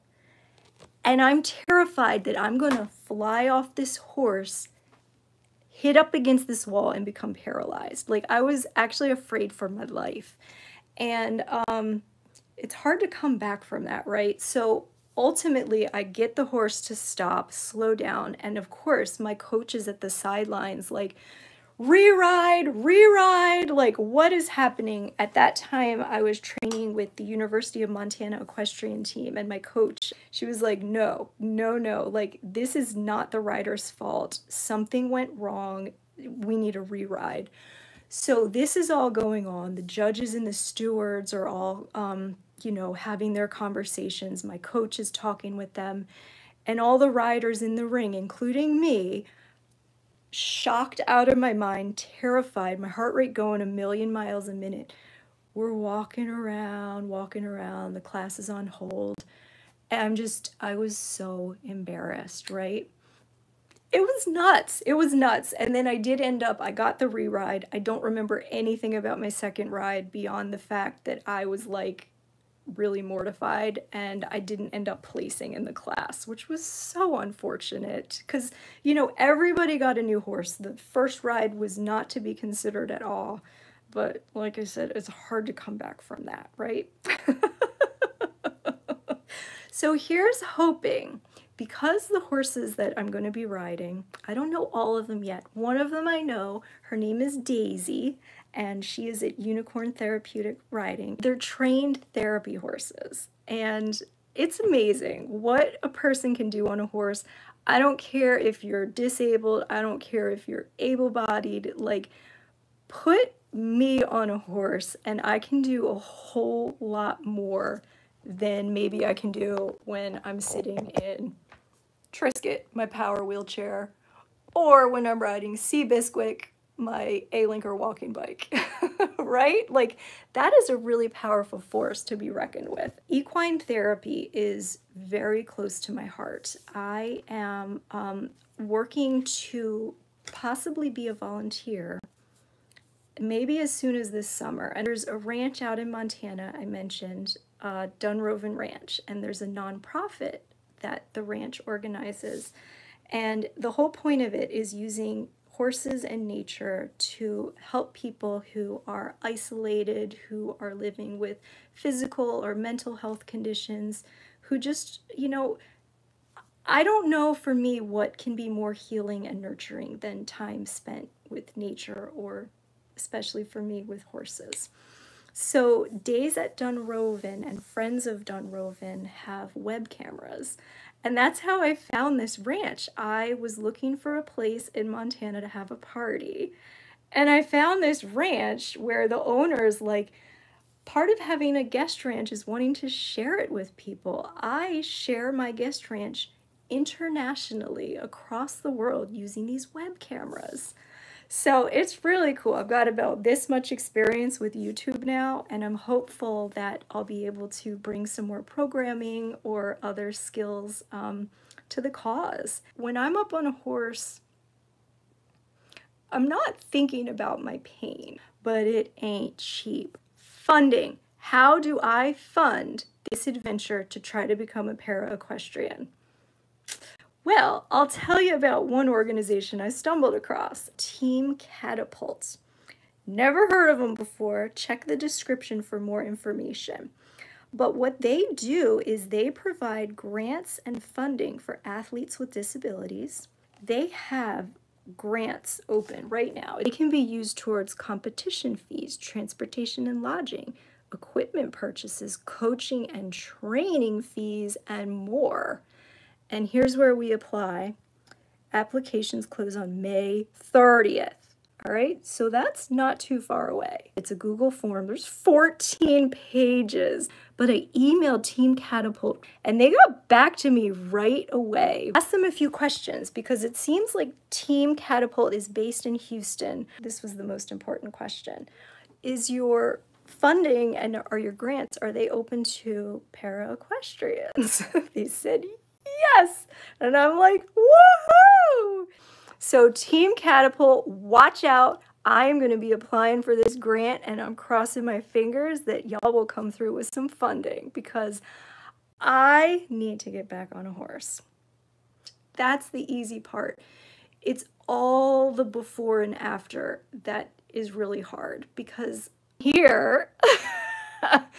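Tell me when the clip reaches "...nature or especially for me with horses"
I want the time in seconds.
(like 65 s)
171 s.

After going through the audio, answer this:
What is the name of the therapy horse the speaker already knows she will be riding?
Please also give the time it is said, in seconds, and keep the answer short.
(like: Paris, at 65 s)
Daisy, at 97 s.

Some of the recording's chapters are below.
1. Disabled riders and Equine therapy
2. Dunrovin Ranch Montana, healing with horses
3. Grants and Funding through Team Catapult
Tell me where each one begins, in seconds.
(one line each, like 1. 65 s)
1. 101 s
2. 138 s
3. 212 s.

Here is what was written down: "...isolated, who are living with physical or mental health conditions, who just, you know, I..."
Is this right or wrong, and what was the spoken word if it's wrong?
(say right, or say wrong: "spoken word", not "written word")
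right.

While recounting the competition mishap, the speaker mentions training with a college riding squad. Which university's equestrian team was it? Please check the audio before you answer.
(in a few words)
University of Montana.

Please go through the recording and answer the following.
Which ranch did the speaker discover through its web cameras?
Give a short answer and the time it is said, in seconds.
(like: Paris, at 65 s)
Dunrovin Ranch, at 147 s.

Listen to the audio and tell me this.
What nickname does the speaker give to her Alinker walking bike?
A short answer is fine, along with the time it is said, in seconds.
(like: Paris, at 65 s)
Sea Bisquick, at 125 s.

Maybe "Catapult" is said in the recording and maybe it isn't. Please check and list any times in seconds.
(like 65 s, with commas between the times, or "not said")
231 s, 268 s, 274 s, 290 s.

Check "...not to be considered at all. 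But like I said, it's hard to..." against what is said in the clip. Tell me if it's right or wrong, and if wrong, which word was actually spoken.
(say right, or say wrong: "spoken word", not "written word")
right.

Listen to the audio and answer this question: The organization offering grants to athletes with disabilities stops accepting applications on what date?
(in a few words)
May 30th.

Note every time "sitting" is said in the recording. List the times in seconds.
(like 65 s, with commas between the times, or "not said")
120 s.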